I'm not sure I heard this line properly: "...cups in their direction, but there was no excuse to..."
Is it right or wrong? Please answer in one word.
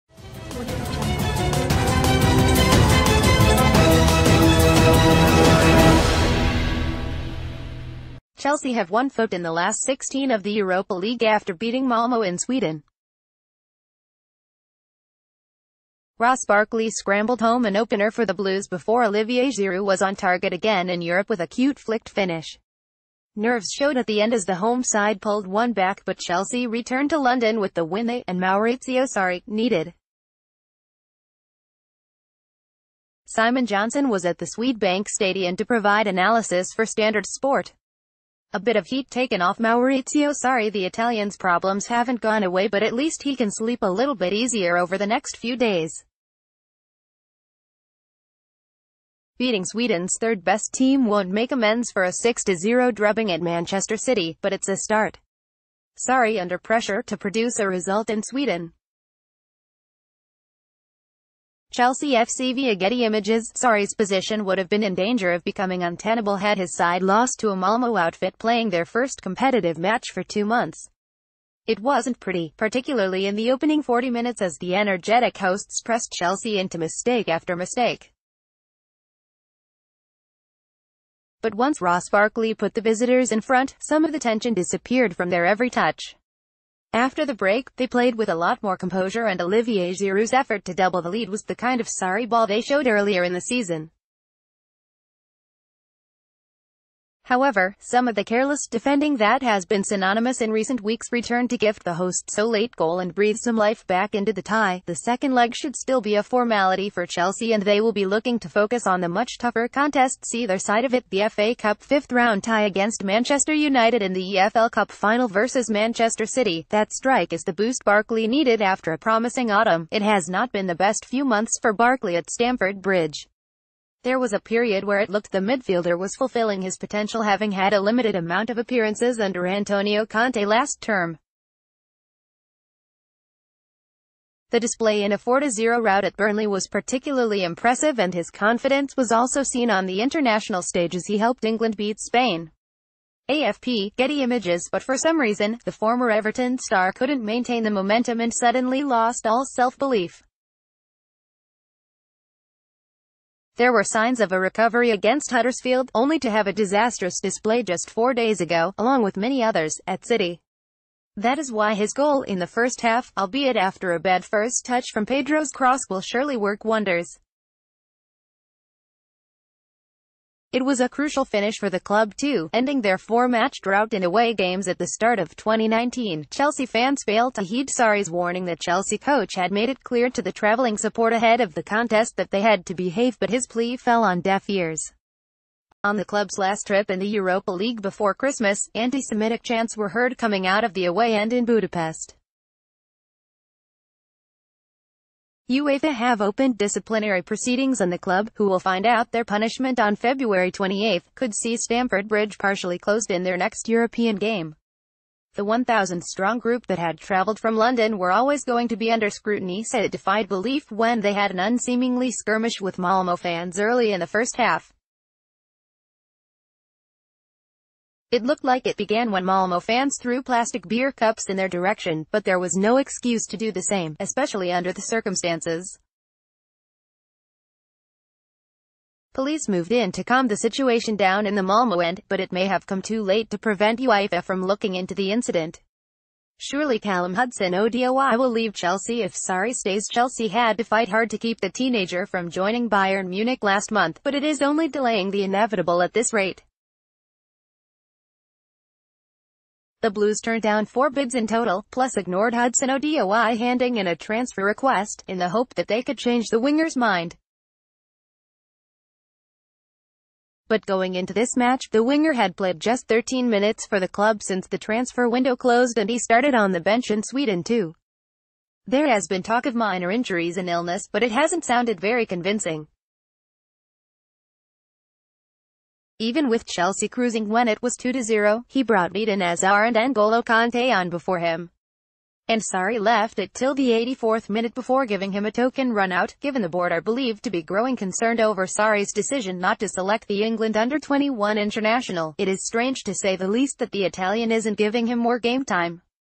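right.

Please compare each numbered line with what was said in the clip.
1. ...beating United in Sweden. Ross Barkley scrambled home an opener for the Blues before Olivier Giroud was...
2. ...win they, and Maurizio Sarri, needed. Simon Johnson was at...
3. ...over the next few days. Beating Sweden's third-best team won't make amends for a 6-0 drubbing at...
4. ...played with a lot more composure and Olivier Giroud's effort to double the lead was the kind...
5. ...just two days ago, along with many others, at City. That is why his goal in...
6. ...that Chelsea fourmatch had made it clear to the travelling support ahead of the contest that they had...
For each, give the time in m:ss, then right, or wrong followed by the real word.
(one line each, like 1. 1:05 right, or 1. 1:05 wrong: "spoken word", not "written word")
1. 0:11 wrong: "Malmo", not "United"
2. 0:27 right
3. 0:44 right
4. 1:27 right
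5. 2:37 wrong: "four", not "two"
6. 2:58 wrong: "coach", not "fourmatch".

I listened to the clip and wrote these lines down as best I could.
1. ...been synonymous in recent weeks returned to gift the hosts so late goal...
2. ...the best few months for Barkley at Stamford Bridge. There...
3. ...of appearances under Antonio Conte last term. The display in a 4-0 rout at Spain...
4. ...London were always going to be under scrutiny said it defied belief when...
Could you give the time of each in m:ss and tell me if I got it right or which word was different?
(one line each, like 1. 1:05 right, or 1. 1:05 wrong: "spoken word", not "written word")
1. 1:39 right
2. 2:00 right
3. 2:08 wrong: "Burnley", not "Spain"
4. 3:27 right.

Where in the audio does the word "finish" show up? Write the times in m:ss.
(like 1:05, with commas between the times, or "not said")
0:22, 2:51.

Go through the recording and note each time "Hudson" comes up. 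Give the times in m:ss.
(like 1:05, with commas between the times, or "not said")
3:57, 4:12.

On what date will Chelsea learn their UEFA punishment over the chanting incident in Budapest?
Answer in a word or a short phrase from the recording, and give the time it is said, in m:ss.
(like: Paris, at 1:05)
February 28, at 3:19.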